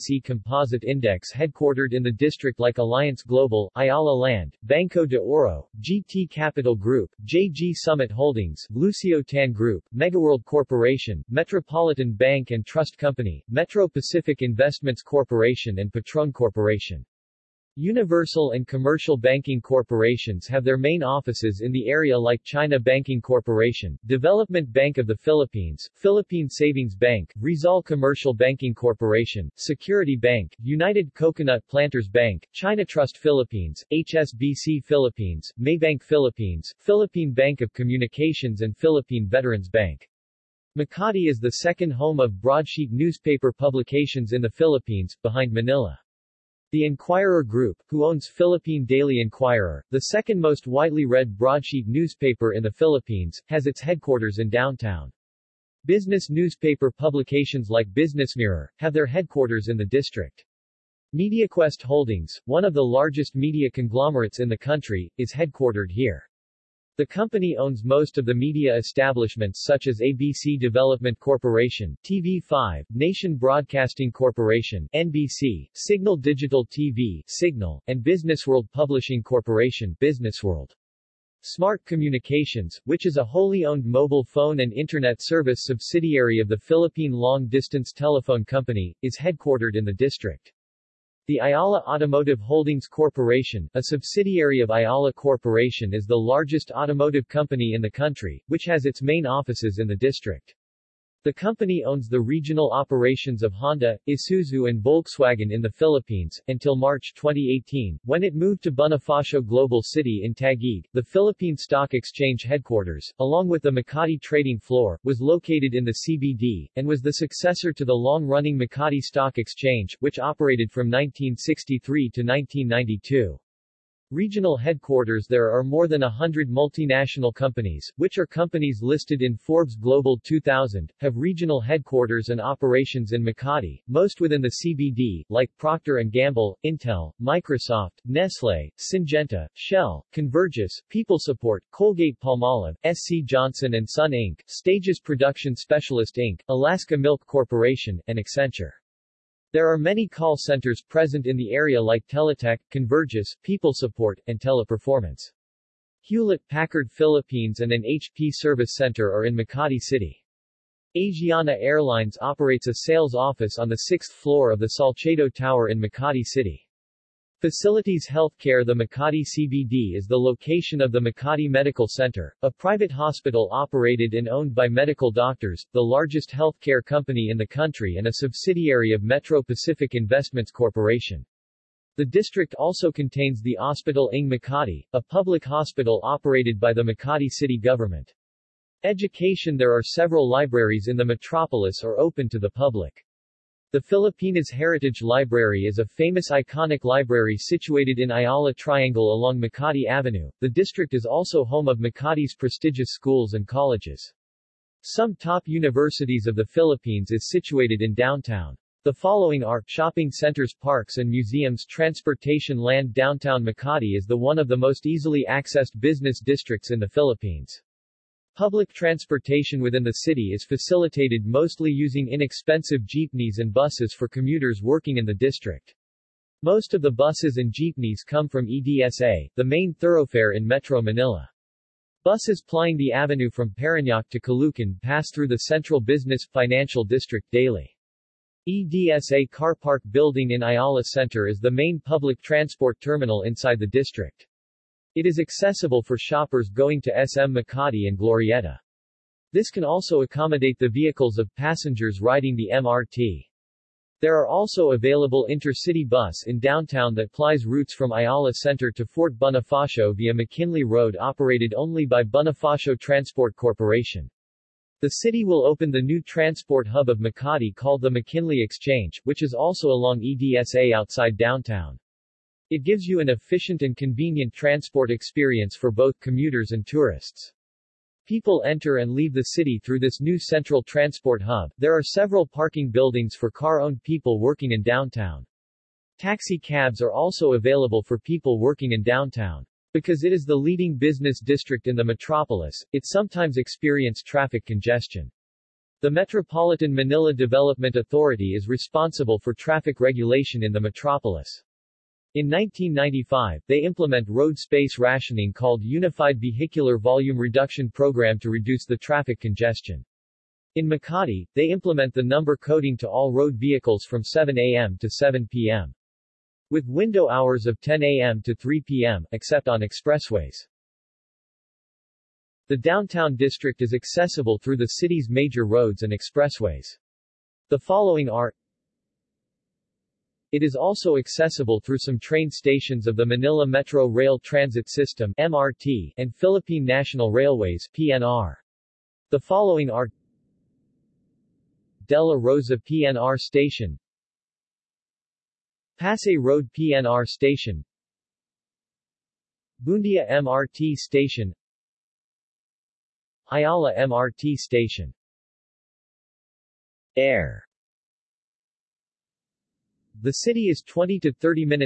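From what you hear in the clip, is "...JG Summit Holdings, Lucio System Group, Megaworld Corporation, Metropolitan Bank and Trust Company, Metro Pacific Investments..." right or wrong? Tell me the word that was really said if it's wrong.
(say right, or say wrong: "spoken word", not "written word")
wrong: "Tan", not "System".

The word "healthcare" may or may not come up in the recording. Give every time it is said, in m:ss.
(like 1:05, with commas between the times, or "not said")
2:48, 2:56.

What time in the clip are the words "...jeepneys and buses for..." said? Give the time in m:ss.
3:42.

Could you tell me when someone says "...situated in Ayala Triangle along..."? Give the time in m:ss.
3:17.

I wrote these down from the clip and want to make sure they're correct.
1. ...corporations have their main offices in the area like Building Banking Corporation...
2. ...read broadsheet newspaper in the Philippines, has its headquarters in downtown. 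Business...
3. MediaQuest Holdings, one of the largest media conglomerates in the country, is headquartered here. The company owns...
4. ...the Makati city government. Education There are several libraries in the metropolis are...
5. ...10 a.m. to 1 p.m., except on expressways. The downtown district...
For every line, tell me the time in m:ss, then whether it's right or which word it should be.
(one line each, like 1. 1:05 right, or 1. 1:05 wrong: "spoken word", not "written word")
1. 0:19 wrong: "China", not "Building"
2. 0:51 right
3. 1:01 right
4. 3:06 right
5. 5:17 wrong: "3", not "1".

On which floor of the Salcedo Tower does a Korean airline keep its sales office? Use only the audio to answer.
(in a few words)
sixth floor.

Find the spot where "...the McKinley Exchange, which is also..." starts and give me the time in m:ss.
4:27.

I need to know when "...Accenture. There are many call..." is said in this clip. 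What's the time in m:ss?
2:28.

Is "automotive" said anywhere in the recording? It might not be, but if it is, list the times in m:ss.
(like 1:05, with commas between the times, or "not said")
1:31, 1:36.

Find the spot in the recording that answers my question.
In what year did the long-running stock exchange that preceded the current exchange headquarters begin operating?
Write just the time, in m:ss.
2:00.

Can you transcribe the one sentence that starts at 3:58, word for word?
EDSA Car Park Building in Ayala Center is the main public transport terminal inside the district.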